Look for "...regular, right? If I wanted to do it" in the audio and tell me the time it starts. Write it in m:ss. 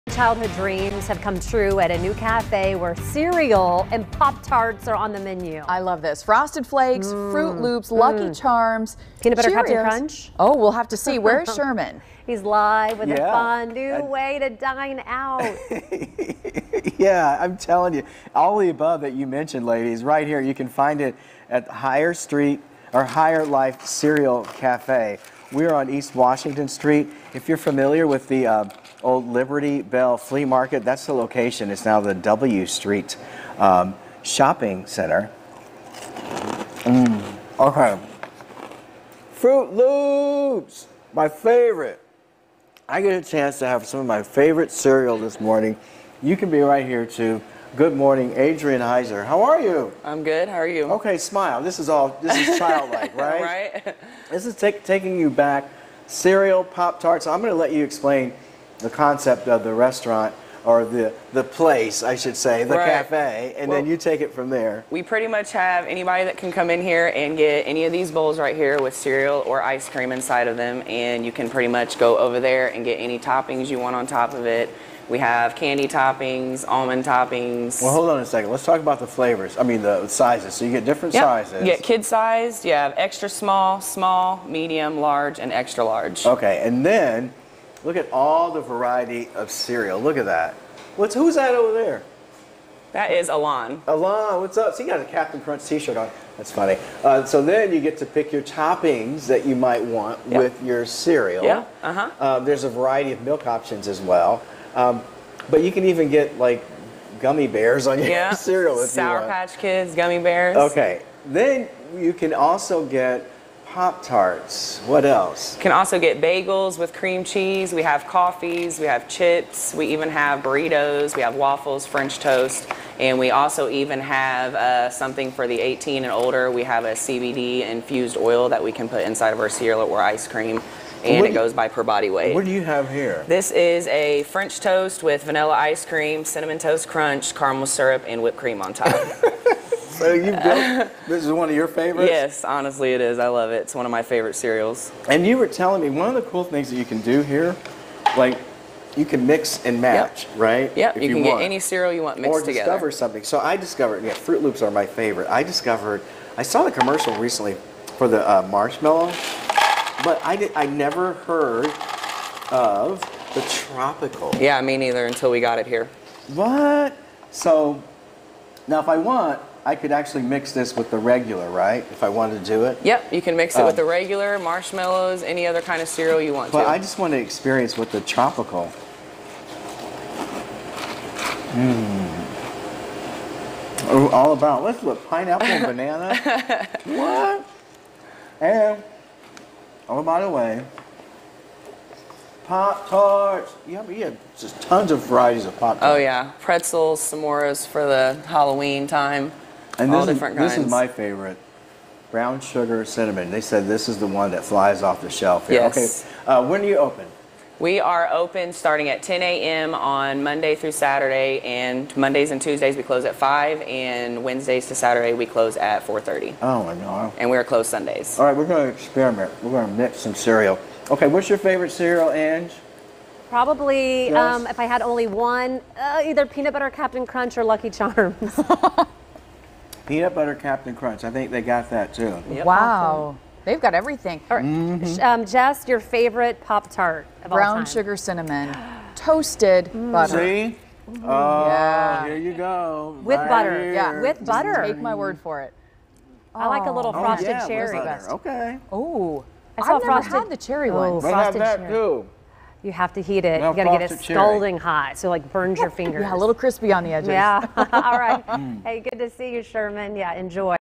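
2:50.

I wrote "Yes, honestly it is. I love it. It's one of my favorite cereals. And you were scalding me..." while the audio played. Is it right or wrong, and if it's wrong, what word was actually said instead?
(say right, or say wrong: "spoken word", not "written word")
wrong: "telling", not "scalding".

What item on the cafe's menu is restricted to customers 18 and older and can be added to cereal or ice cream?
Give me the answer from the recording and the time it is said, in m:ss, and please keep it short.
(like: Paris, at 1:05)
CBD infused oil, at 2:06.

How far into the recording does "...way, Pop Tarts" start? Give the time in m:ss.
3:10.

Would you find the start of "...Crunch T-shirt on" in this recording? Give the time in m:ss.
1:35.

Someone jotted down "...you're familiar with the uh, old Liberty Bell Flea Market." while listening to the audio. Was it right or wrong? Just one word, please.
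right.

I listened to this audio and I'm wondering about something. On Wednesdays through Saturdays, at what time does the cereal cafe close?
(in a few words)
4:30.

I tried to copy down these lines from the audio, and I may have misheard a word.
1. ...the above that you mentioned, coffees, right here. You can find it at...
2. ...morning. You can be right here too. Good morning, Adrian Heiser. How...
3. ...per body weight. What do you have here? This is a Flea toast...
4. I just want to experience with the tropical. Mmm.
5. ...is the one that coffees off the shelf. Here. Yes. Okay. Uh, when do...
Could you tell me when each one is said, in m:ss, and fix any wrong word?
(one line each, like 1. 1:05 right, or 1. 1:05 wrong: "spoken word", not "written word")
1. 0:18 wrong: "ladies", not "coffees"
2. 0:45 right
3. 2:11 wrong: "French", not "Flea"
4. 2:56 right
5. 3:23 wrong: "flies", not "coffees".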